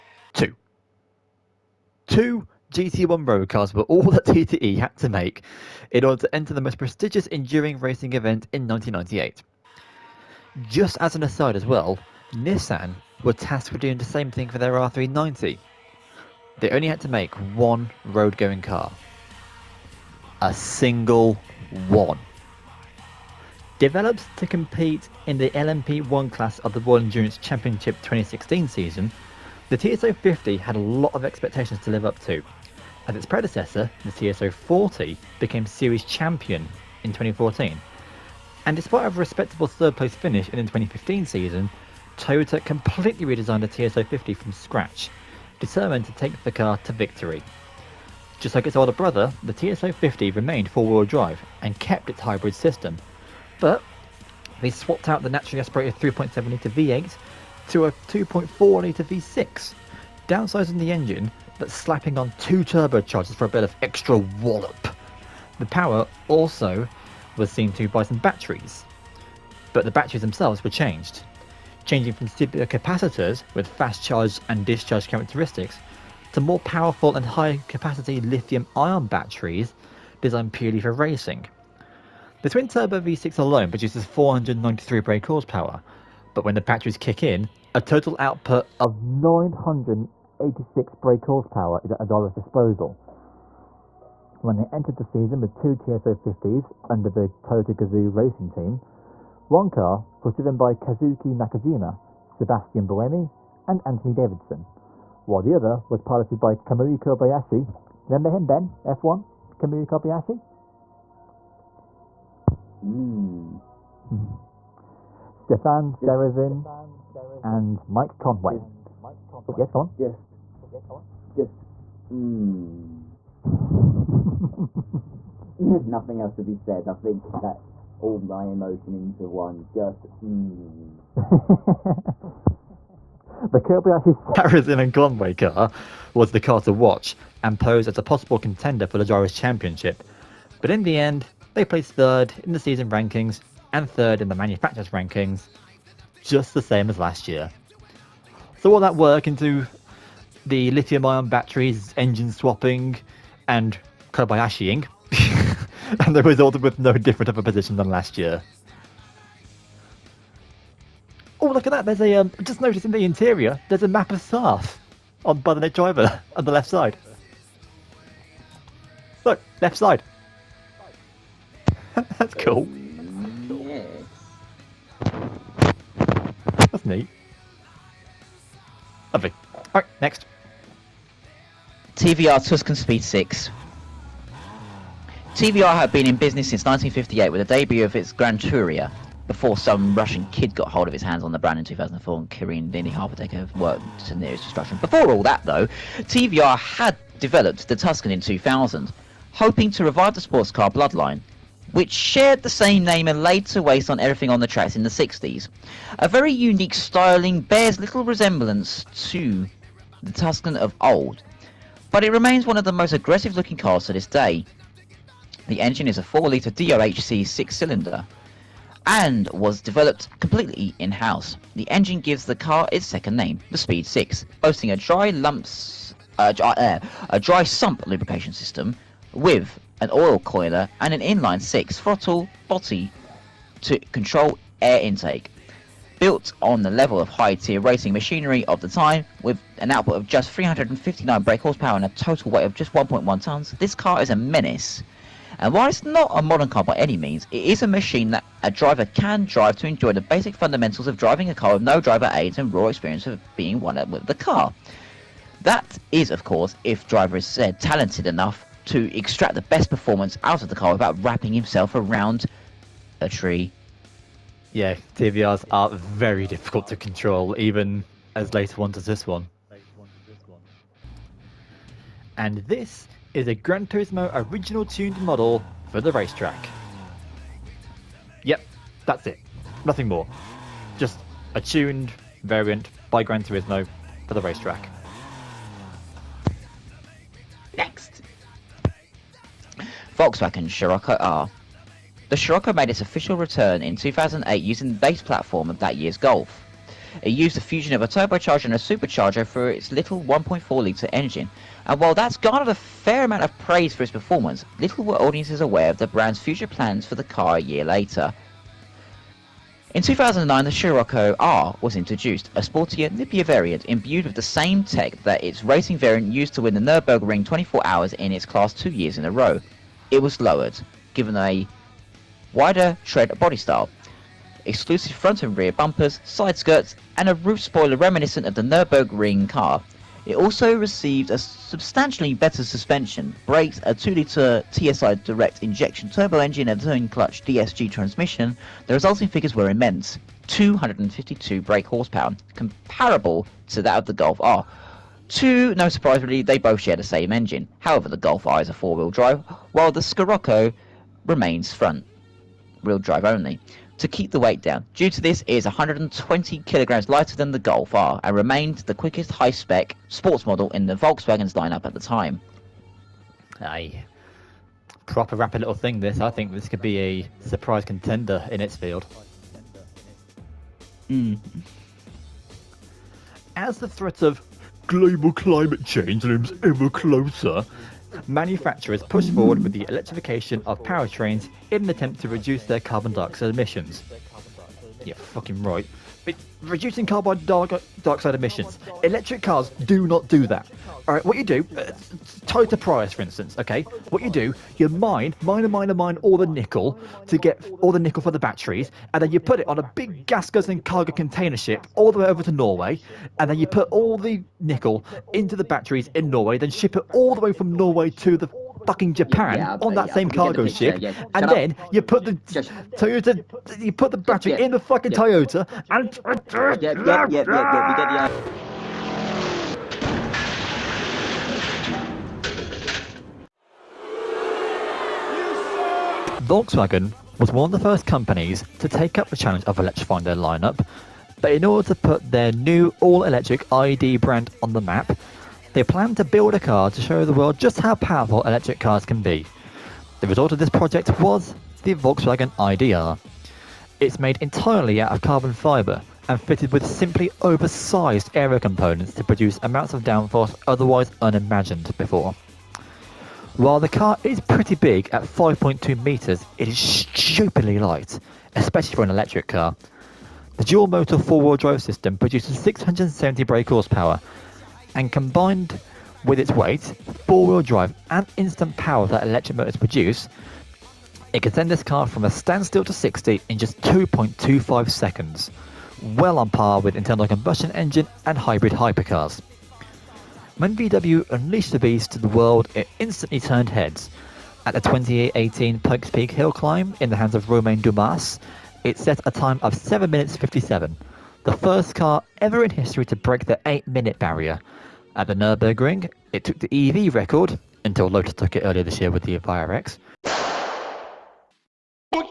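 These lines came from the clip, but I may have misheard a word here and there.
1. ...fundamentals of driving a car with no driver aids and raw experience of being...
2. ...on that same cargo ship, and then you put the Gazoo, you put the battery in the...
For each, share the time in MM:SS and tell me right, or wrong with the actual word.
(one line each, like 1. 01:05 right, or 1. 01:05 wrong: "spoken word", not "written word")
1. 04:10 right
2. 06:49 wrong: "Toyota", not "Gazoo".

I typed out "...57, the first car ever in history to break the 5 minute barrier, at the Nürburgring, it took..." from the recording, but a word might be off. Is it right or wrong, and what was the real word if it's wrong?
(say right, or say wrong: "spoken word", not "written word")
wrong: "8", not "5".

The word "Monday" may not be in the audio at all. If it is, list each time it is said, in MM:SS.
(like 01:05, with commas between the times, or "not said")
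not said.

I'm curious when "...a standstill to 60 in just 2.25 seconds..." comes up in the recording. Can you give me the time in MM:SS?
07:52.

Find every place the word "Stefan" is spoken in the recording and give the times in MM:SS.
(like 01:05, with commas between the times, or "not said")
01:55.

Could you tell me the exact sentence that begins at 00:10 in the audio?
Just as an aside as well, Nissan were tasked with doing the same thing for their R390.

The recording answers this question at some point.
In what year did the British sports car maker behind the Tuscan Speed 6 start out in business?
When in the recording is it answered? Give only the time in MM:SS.
03:06.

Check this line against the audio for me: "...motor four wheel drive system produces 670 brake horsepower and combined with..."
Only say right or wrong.
right.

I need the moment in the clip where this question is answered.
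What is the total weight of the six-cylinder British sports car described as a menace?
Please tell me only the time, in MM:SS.
04:02.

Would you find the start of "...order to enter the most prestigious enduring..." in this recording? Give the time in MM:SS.
00:06.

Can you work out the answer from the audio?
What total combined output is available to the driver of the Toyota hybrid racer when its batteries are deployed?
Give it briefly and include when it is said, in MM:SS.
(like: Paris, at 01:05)
986 brake horsepower, at 01:29.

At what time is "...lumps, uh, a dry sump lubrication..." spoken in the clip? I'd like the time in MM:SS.
03:45.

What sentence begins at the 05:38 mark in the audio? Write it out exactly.
The resulting figures were immense 252 brake horsepower, comparable to that of the Golf R.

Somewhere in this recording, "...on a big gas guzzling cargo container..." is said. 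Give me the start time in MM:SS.
06:39.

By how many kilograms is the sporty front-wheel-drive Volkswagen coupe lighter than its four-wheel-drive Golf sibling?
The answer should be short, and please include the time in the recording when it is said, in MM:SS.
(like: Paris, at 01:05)
120, at 05:55.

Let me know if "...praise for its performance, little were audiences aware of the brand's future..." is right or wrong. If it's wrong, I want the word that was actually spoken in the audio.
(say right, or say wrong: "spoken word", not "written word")
right.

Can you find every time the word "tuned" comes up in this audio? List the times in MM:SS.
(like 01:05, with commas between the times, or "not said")
04:34, 04:41.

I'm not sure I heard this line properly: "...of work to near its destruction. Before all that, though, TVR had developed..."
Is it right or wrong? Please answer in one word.
right.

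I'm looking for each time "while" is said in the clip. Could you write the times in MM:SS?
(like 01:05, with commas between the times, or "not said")
01:45, 04:05, 05:01, 05:49, 07:33.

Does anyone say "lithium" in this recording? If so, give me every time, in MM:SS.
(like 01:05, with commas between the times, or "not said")
01:18, 02:30.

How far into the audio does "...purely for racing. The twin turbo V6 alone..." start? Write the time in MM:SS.
01:20.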